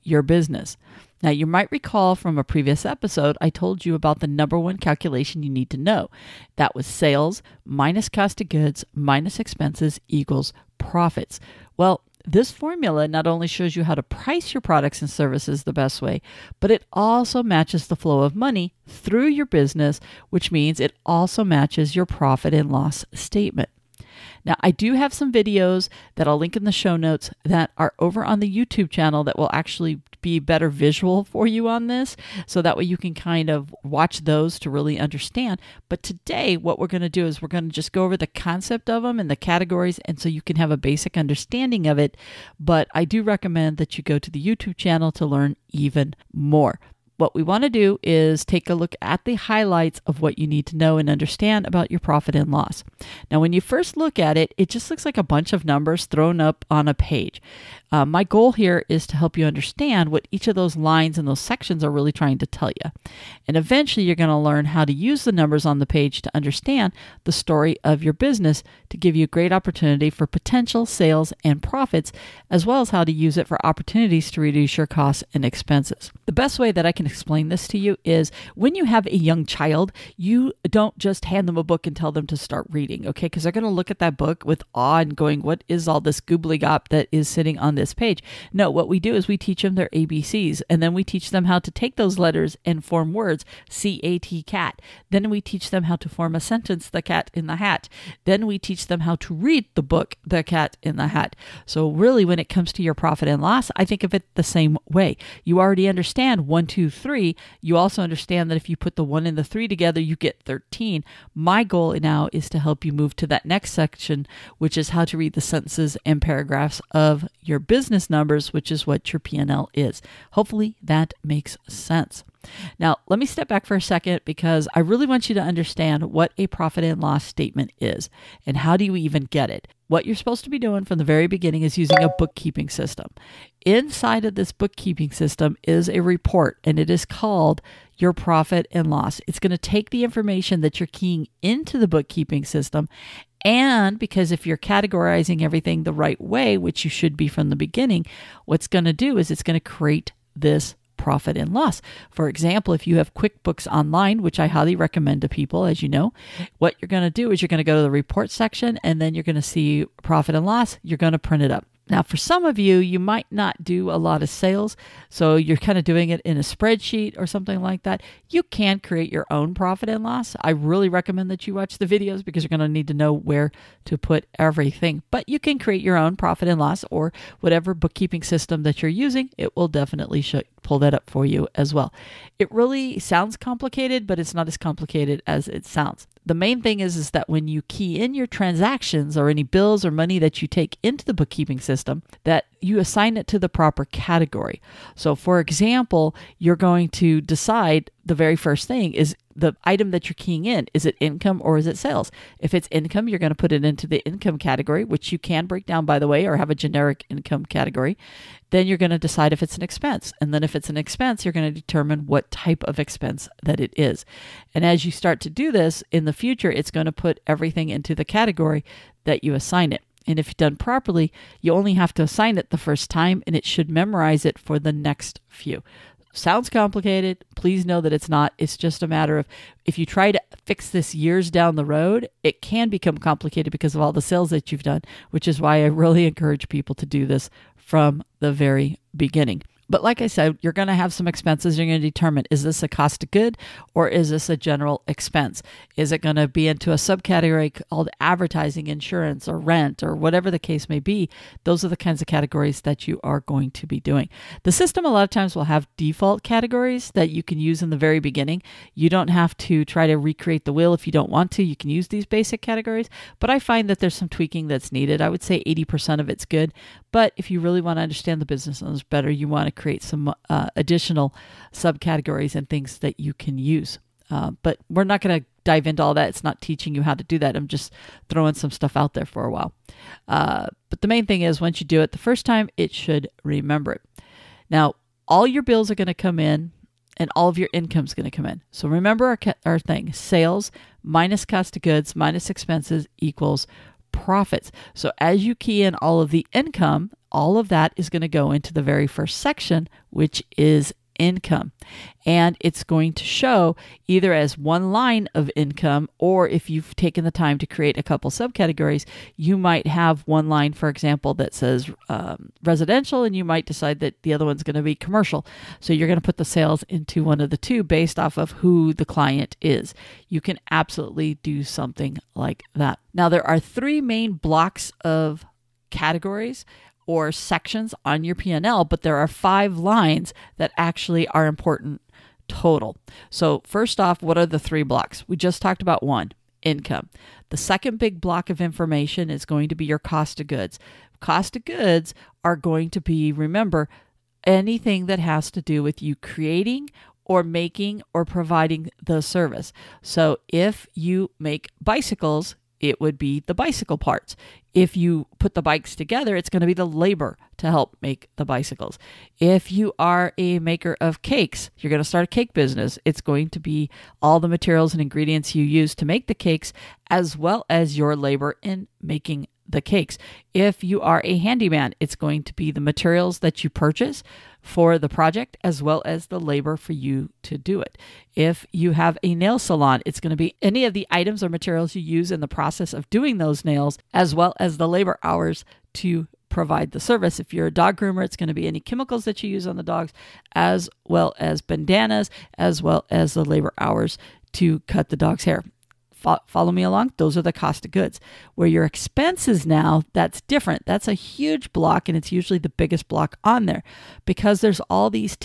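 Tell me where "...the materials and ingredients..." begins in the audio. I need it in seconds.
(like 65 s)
364 s.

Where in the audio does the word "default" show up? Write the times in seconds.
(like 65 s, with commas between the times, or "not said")
255 s.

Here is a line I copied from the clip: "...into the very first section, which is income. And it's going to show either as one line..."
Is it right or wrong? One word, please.
right.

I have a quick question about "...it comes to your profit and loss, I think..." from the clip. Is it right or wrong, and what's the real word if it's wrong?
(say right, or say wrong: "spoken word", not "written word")
right.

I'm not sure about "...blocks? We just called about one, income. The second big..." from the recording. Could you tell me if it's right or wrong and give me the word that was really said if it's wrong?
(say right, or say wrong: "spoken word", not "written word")
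wrong: "talked", not "called".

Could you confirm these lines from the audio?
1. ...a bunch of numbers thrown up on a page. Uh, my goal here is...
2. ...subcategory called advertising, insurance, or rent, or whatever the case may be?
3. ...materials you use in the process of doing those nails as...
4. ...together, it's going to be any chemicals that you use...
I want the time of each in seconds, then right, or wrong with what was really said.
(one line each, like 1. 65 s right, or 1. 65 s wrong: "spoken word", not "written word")
1. 55 s right
2. 246 s right
3. 381 s right
4. 387 s wrong: "groomer", not "together".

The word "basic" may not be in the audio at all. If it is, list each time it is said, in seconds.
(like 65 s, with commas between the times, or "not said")
40 s, 262 s.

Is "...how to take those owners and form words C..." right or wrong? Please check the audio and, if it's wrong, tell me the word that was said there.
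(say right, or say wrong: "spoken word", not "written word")
wrong: "letters", not "owners".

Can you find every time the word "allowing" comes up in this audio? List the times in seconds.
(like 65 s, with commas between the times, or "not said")
not said.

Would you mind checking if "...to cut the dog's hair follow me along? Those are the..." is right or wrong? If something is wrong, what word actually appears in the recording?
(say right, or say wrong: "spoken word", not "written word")
right.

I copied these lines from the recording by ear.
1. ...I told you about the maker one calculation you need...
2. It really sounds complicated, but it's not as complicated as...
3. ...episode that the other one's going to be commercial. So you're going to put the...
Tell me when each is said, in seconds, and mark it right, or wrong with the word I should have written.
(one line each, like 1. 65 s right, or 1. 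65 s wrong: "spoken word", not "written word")
1. 3 s wrong: "number", not "maker"
2. 182 s right
3. 313 s wrong: "decide", not "episode".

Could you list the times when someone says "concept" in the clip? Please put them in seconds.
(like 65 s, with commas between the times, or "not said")
38 s.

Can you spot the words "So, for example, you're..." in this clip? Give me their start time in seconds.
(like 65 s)
194 s.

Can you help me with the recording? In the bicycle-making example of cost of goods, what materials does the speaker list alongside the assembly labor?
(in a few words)
Bicycle parts.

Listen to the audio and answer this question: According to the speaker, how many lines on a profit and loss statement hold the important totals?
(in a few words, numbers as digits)
5.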